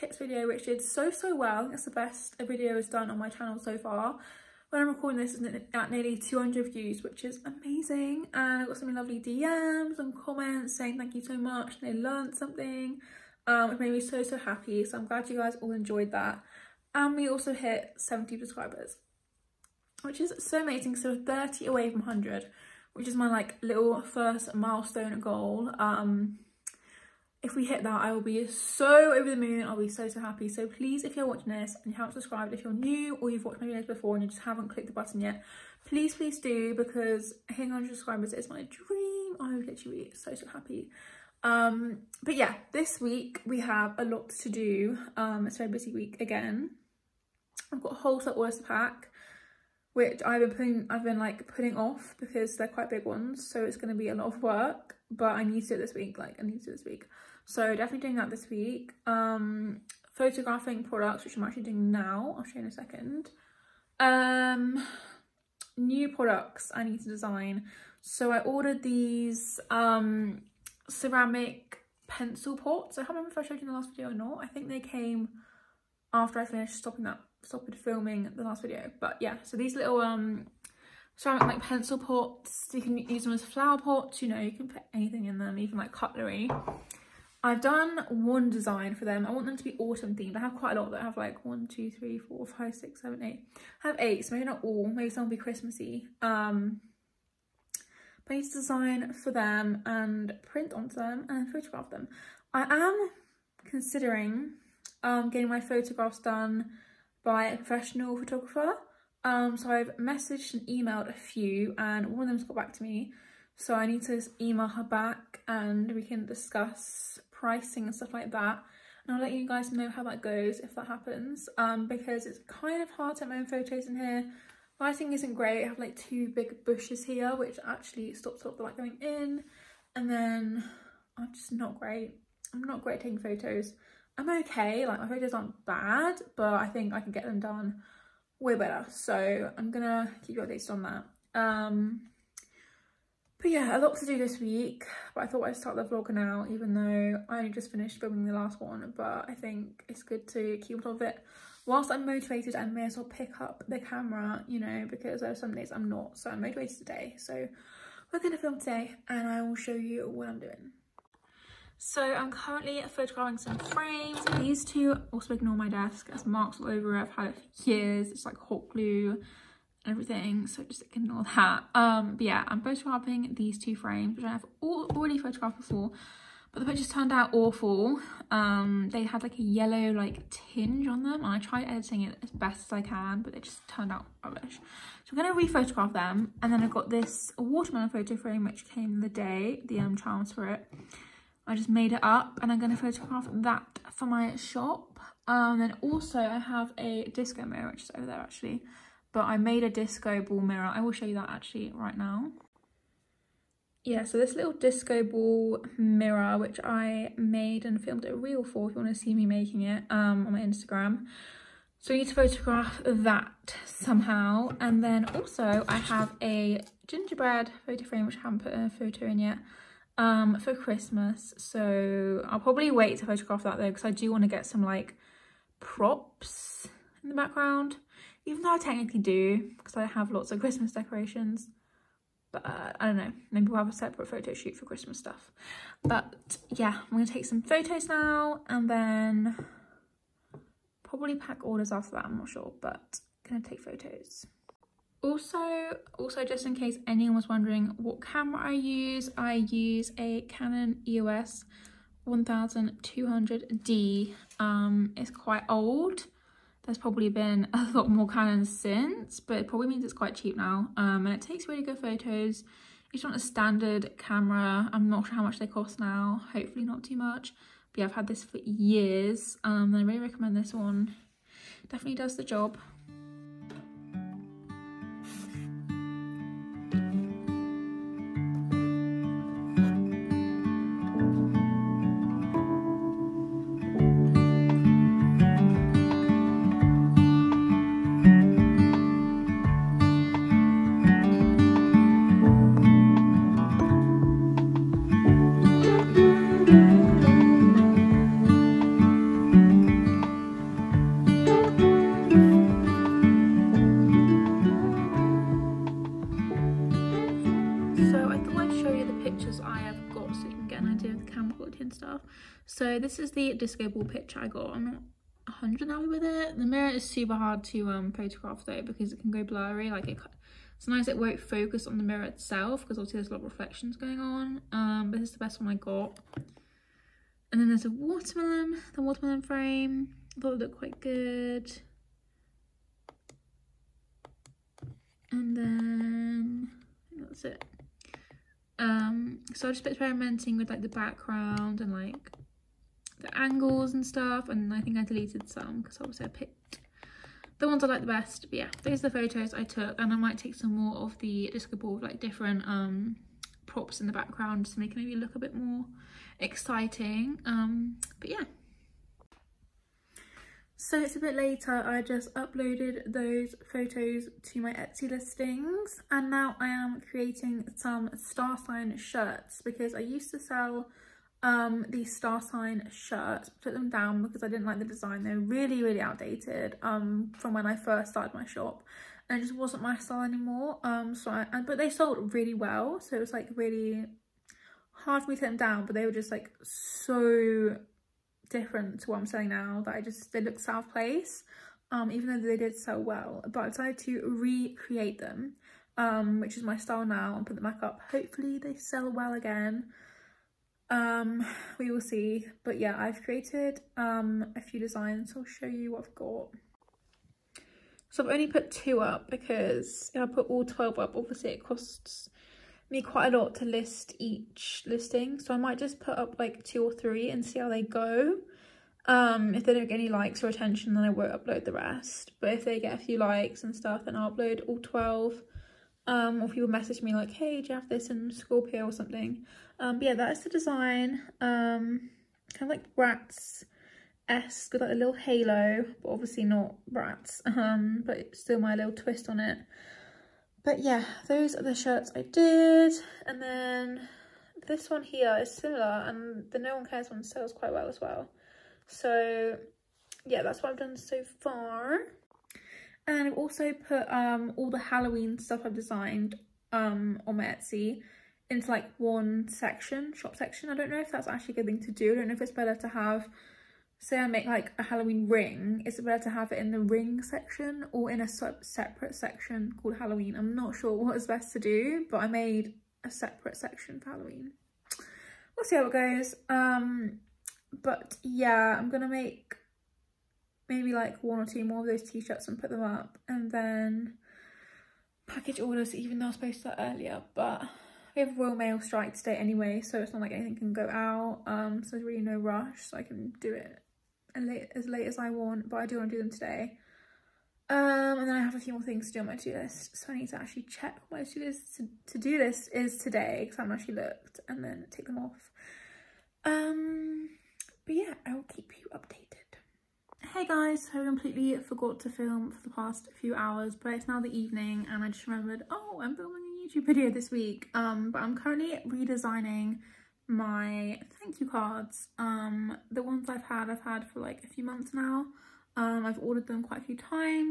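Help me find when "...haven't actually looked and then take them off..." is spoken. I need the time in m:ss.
8:23.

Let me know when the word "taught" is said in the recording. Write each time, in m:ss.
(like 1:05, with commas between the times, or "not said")
not said.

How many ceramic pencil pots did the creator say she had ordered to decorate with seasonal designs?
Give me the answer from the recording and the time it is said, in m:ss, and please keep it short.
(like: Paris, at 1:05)
8, at 1:33.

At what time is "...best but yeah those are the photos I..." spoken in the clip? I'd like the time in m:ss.
5:47.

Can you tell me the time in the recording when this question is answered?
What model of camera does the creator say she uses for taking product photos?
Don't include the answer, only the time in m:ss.
4:10.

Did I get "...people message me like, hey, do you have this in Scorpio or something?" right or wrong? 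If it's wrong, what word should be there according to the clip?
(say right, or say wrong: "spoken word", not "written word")
right.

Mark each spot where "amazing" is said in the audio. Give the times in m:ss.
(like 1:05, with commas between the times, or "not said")
0:07, 0:20.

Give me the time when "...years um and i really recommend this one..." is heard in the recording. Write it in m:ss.
4:28.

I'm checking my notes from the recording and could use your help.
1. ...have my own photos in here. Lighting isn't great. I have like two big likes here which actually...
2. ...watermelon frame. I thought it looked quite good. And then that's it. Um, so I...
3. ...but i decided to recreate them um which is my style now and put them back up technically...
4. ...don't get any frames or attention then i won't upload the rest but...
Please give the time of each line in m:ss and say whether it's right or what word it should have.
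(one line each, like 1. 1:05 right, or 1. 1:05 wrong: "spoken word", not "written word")
1. 2:03 wrong: "bushes", not "likes"
2. 5:28 right
3. 6:33 wrong: "hopefully", not "technically"
4. 6:59 wrong: "likes", not "frames".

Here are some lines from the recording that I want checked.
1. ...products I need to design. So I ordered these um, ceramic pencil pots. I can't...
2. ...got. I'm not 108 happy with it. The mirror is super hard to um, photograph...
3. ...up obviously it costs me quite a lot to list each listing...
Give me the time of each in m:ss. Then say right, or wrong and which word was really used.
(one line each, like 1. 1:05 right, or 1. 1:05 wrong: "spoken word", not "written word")
1. 1:06 right
2. 5:14 wrong: "100", not "108"
3. 6:50 right.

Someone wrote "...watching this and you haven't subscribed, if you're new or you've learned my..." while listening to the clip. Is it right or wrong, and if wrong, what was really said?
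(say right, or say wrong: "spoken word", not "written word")
wrong: "watched", not "learned".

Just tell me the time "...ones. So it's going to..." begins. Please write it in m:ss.
0:53.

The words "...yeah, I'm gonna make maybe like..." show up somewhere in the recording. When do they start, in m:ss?
7:58.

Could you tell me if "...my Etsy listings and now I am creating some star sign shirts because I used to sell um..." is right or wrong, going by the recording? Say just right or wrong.
right.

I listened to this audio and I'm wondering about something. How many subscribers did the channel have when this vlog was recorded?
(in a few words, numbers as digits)
70.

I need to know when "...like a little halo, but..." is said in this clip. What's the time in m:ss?
7:14.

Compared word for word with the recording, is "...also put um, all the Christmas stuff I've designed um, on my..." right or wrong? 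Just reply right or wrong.
wrong.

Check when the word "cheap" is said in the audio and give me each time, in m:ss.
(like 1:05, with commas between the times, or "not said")
4:20.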